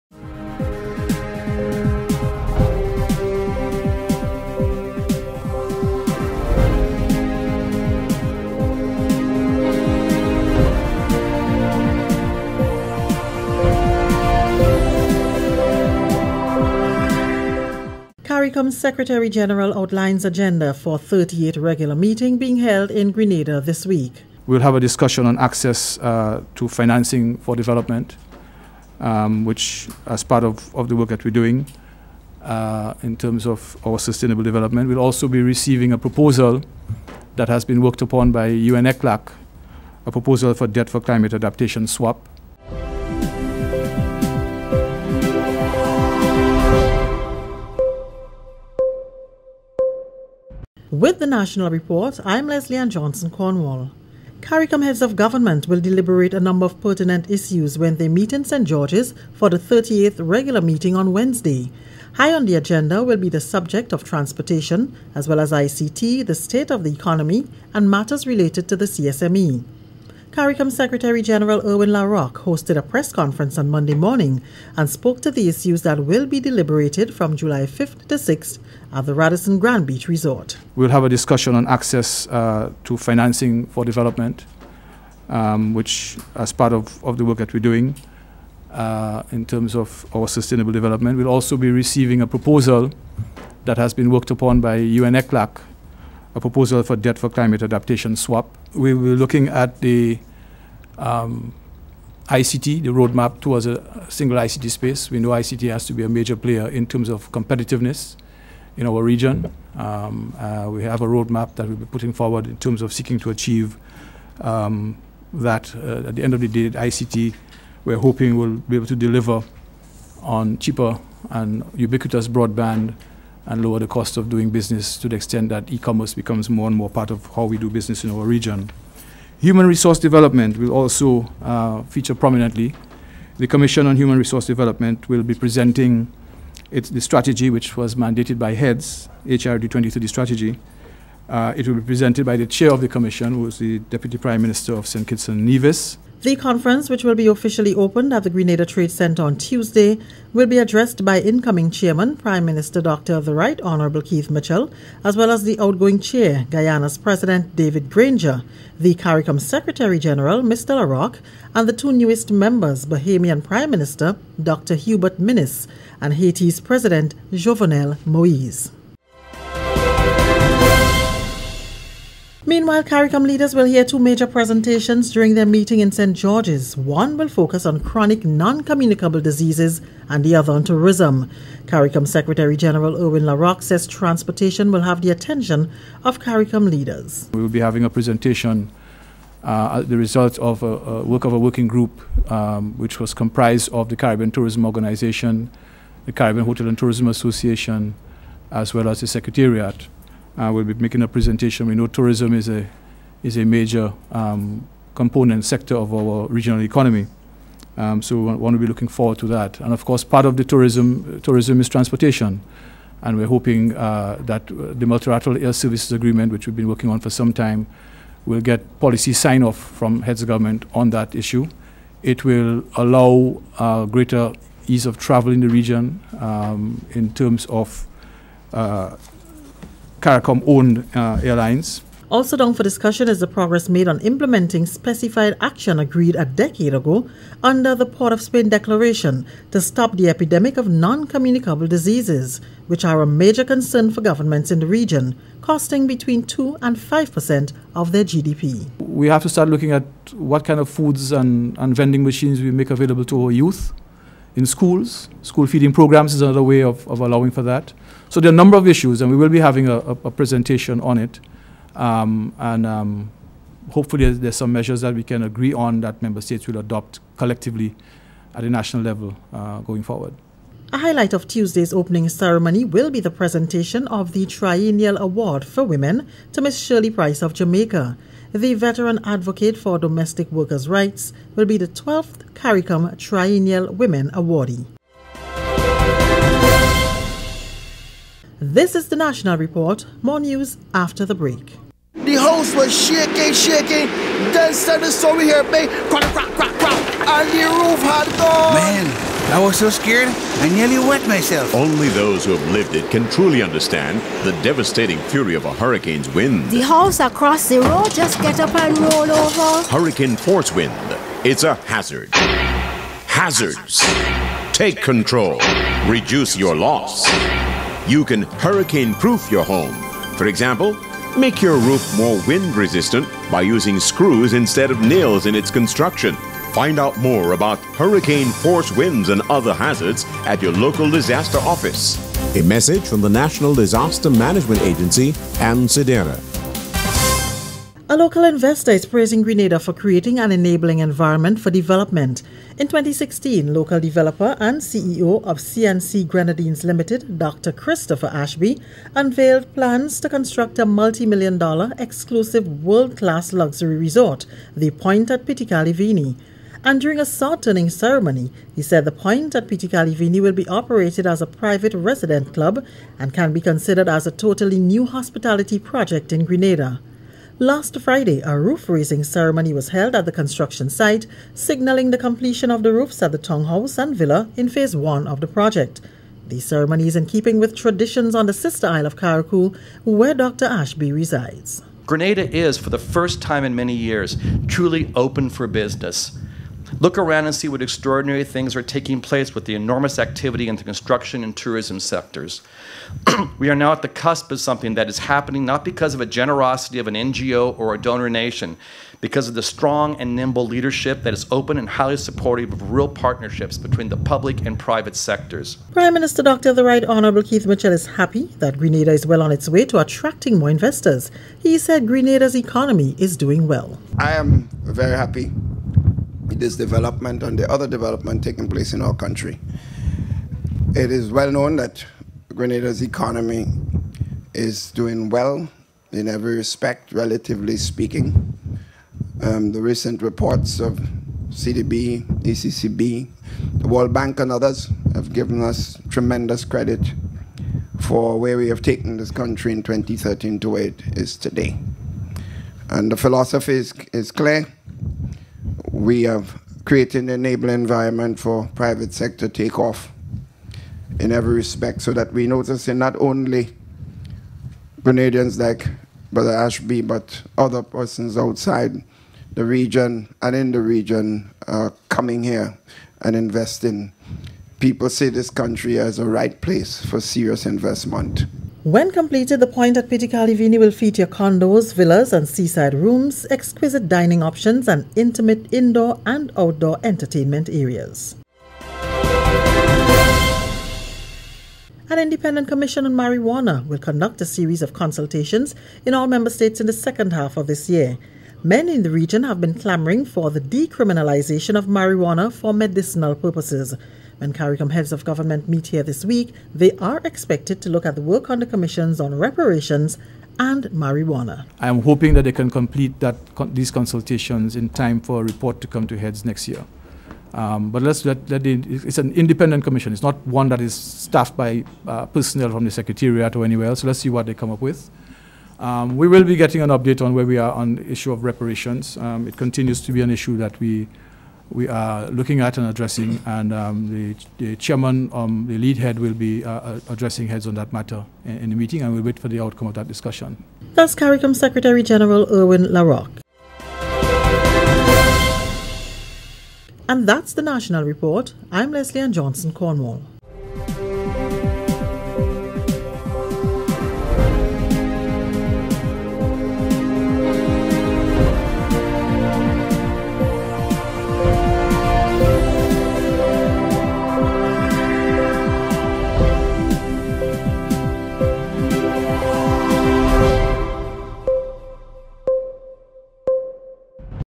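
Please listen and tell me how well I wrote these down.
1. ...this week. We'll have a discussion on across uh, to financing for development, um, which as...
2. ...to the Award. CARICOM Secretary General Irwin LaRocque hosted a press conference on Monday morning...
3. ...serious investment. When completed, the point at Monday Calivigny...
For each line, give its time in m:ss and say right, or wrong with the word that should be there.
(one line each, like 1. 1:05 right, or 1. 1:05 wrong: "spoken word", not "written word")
1. 0:23 wrong: "access", not "across"
2. 1:08 wrong: "CSME", not "Award"
3. 7:47 wrong: "Petite", not "Monday".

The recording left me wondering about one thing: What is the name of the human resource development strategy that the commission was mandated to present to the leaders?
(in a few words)
HRD 2030.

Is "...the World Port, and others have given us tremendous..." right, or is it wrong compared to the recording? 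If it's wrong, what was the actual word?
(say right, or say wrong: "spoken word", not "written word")
wrong: "Bank", not "Port".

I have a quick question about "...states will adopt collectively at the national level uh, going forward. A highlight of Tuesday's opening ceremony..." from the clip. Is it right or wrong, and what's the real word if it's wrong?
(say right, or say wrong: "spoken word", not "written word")
right.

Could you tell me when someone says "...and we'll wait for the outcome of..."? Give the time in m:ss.
8:48.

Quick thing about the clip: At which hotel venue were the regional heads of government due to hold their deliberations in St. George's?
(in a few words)
Radisson Grand Beach Resort.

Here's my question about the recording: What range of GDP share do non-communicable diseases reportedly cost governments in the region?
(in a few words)
2 to 5 percent.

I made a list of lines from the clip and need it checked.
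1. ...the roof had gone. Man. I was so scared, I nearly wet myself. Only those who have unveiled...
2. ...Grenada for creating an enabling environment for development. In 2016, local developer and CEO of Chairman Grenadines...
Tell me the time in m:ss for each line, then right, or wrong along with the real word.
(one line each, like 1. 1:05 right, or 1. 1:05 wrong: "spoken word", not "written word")
1. 4:57 wrong: "lived", not "unveiled"
2. 5:39 wrong: "CNC", not "Chairman".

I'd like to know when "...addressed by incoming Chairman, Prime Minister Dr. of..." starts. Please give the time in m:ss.
2:30.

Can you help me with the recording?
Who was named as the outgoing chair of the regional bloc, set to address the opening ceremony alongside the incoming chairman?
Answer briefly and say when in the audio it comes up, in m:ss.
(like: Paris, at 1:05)
David Granger, at 2:37.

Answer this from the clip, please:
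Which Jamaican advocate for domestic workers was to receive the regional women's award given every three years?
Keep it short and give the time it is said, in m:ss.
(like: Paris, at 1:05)
Shirley Price, at 4:36.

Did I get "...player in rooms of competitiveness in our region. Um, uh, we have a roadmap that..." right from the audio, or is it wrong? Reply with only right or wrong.
wrong.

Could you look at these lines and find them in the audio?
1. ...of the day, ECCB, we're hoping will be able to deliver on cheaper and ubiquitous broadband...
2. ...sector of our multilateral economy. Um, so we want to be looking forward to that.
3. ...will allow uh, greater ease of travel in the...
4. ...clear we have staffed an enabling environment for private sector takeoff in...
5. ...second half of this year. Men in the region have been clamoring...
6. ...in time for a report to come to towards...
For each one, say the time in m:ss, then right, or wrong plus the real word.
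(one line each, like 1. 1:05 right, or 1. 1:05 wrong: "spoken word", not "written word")
1. 1:56 wrong: "ICT", not "ECCB"
2. 3:25 wrong: "regional", not "multilateral"
3. 3:42 right
4. 7:24 wrong: "created", not "staffed"
5. 8:06 right
6. 8:24 wrong: "heads", not "towards".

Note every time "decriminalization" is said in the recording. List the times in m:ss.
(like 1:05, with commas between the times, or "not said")
8:10.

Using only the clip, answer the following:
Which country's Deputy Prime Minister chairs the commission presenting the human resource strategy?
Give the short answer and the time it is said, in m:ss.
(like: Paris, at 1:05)
St. Kitts and Nevis, at 2:24.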